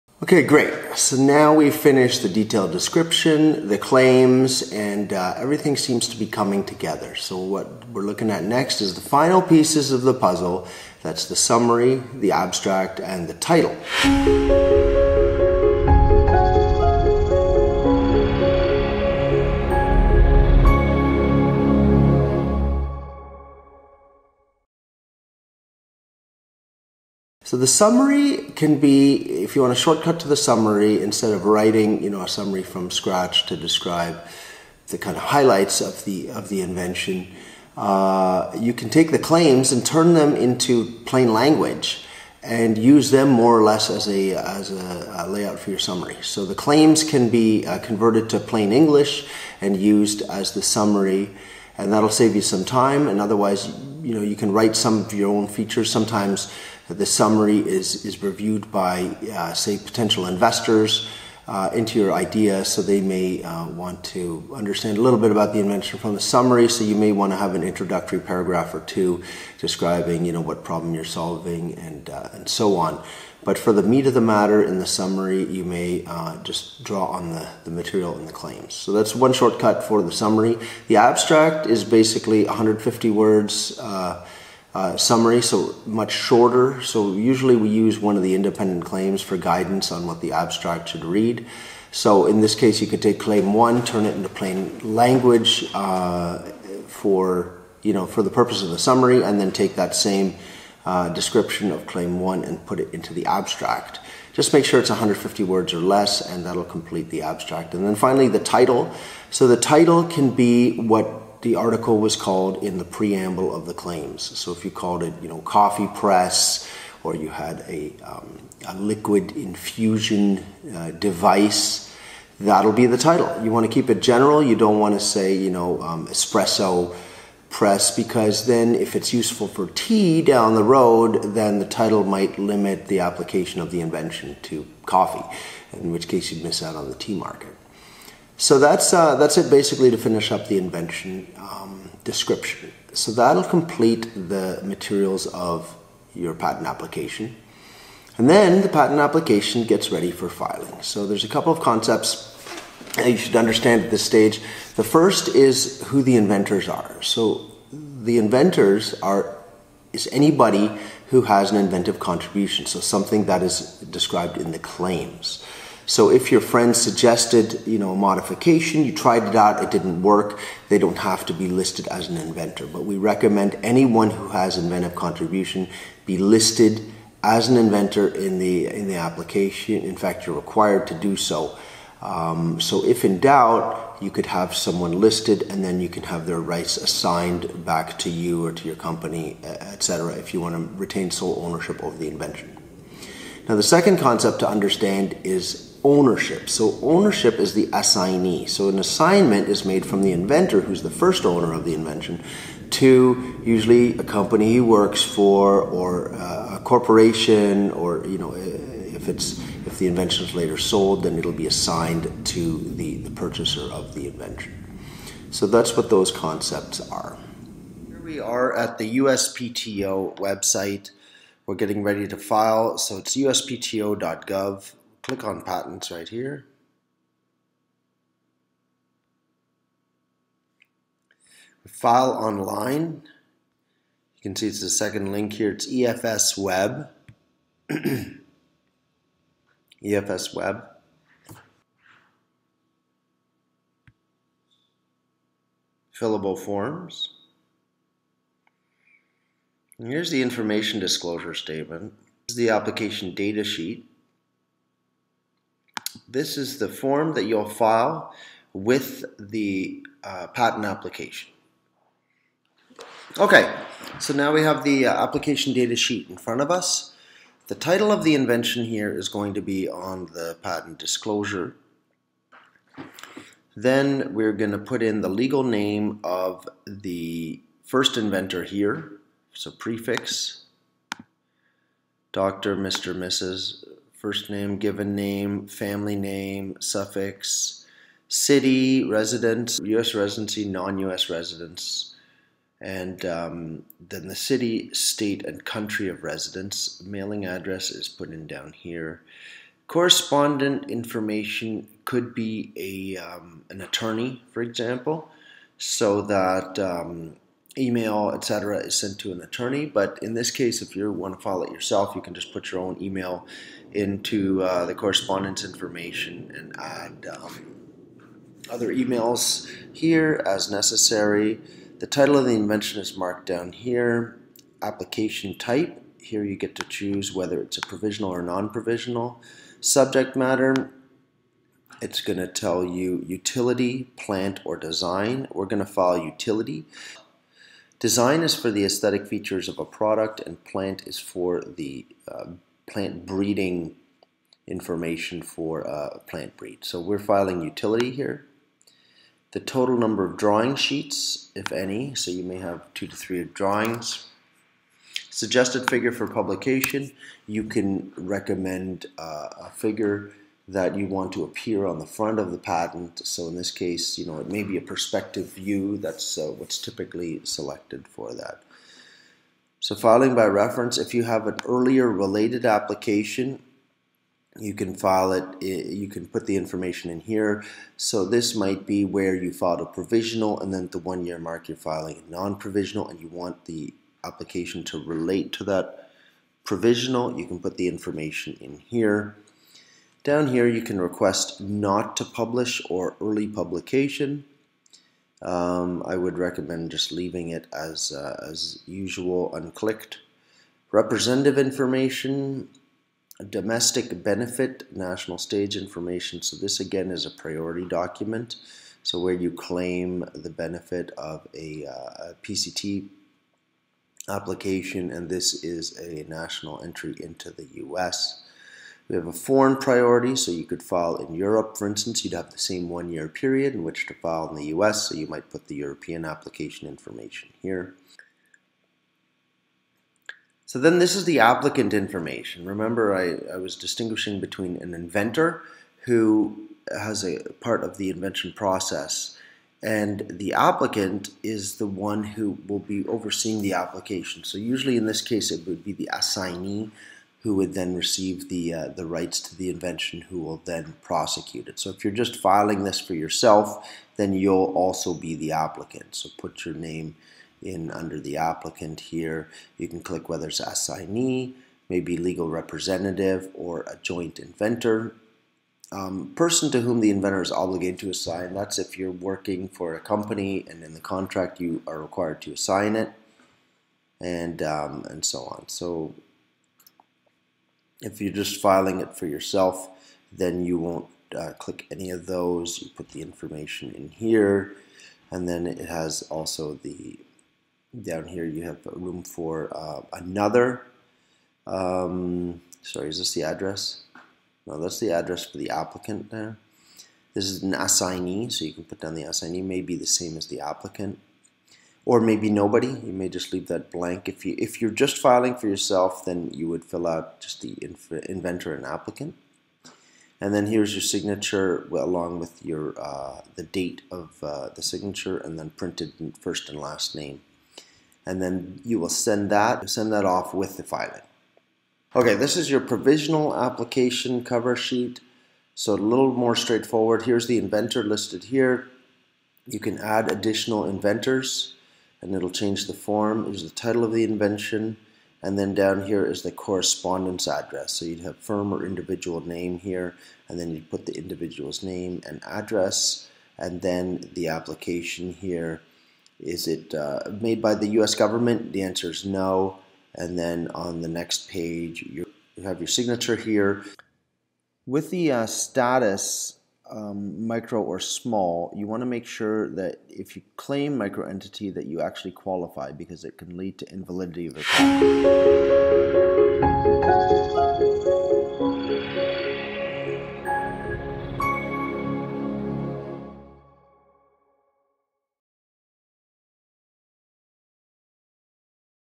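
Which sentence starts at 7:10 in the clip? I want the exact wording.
So then this is the applicant information.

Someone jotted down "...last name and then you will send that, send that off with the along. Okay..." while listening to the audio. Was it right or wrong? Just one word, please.
wrong.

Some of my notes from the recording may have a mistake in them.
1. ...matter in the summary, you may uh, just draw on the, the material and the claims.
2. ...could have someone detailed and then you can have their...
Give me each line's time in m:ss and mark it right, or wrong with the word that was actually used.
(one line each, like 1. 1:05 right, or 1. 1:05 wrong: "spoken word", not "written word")
1. 1:14 right
2. 3:04 wrong: "listed", not "detailed".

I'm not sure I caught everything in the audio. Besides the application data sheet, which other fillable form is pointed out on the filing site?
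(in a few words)
information disclosure statement.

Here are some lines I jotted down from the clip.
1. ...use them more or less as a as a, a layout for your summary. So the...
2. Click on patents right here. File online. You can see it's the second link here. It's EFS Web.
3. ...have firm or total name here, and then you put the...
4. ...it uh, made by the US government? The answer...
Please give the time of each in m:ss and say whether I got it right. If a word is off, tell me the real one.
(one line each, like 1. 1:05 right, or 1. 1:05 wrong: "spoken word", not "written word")
1. 0:42 right
2. 3:45 right
3. 8:57 wrong: "individual", not "total"
4. 9:06 right.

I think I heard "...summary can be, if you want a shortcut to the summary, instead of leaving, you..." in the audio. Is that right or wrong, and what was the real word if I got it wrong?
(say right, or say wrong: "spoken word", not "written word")
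wrong: "writing", not "leaving".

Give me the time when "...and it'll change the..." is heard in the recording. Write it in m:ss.
8:52.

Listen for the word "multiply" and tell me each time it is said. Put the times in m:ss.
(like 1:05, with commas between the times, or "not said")
not said.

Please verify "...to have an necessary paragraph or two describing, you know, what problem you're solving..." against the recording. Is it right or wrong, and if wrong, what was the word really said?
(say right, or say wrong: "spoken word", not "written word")
wrong: "introductory", not "necessary".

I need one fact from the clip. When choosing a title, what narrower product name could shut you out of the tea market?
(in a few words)
espresso press.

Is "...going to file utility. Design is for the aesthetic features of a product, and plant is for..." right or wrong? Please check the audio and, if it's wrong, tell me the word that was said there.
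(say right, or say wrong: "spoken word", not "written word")
right.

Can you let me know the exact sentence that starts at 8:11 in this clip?
Um, sorry, is this the address?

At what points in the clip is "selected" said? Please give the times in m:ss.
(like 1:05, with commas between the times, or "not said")
6:07.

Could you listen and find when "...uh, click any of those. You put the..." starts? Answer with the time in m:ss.
8:01.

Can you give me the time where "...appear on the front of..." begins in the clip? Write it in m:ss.
6:01.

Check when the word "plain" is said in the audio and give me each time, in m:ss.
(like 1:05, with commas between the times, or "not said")
0:41, 0:48, 1:34.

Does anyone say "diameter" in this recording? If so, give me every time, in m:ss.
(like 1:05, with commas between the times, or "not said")
not said.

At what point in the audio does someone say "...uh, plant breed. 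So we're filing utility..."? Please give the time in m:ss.
5:45.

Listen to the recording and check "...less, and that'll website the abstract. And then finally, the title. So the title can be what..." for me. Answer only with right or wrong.
wrong.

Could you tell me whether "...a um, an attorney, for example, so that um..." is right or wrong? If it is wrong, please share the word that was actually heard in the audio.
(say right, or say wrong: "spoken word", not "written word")
right.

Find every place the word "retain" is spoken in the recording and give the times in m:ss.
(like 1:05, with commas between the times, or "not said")
3:10.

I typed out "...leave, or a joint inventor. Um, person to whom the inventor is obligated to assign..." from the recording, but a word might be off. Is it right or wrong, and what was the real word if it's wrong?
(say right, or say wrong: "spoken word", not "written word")
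wrong: "representative", not "leave".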